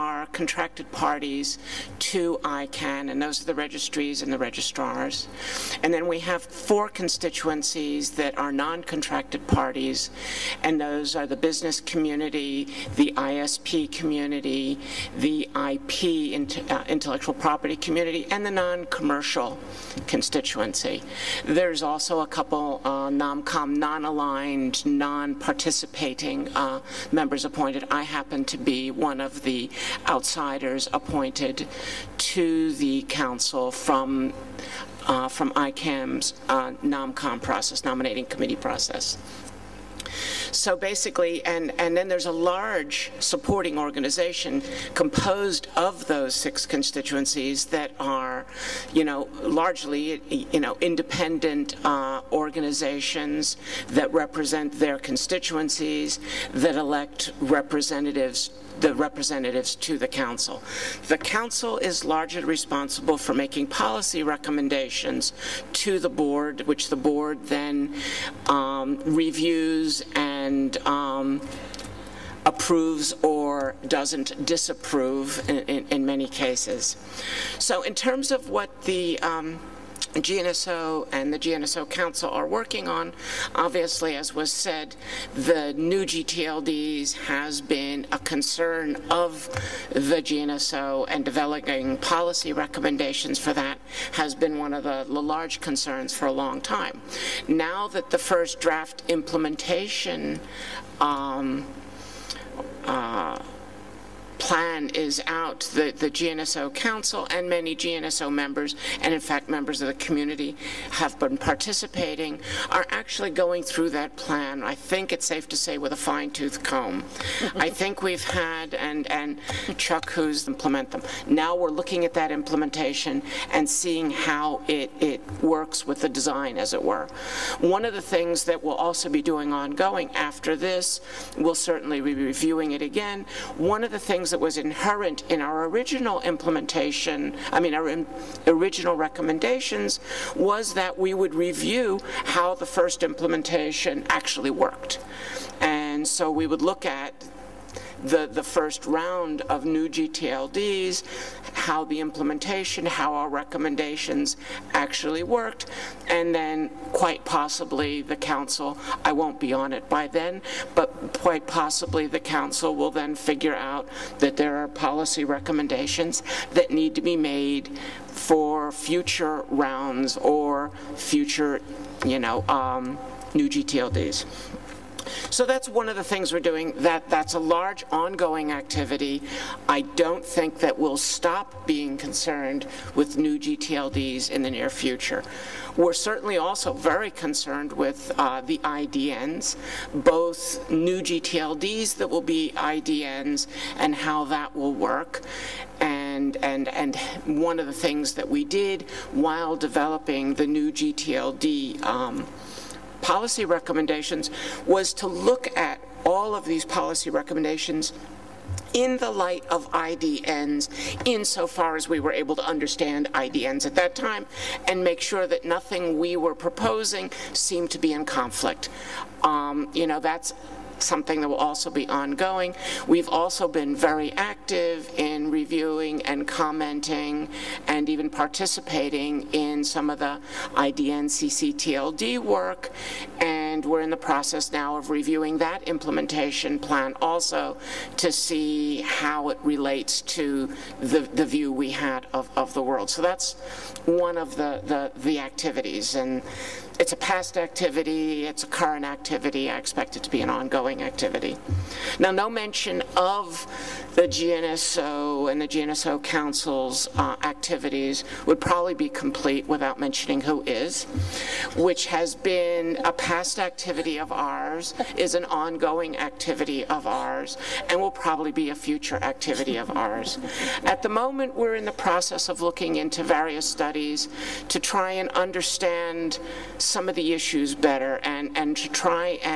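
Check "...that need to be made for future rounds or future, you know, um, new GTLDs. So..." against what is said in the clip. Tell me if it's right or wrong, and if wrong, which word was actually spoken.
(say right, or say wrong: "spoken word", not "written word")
right.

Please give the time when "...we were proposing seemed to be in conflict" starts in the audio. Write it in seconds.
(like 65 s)
215 s.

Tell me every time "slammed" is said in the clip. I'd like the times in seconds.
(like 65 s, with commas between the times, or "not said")
not said.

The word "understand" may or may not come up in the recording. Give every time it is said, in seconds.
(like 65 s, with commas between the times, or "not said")
212 s, 275 s.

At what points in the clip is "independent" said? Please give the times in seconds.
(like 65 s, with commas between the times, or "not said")
50 s.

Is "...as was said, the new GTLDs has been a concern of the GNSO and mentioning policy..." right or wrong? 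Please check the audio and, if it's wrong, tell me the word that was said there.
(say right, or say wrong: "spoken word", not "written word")
wrong: "developing", not "mentioning".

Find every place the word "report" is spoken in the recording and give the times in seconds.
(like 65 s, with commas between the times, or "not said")
not said.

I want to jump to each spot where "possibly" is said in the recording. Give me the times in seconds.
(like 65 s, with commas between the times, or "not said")
157 s, 161 s.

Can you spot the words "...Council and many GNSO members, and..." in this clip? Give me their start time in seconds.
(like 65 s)
106 s.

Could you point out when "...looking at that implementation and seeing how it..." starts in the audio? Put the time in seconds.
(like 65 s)
121 s.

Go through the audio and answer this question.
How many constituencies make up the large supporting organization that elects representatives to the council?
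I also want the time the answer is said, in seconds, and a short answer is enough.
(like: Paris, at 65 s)
6, at 46 s.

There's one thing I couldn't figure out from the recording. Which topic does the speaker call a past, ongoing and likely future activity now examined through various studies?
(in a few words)
WHOIS.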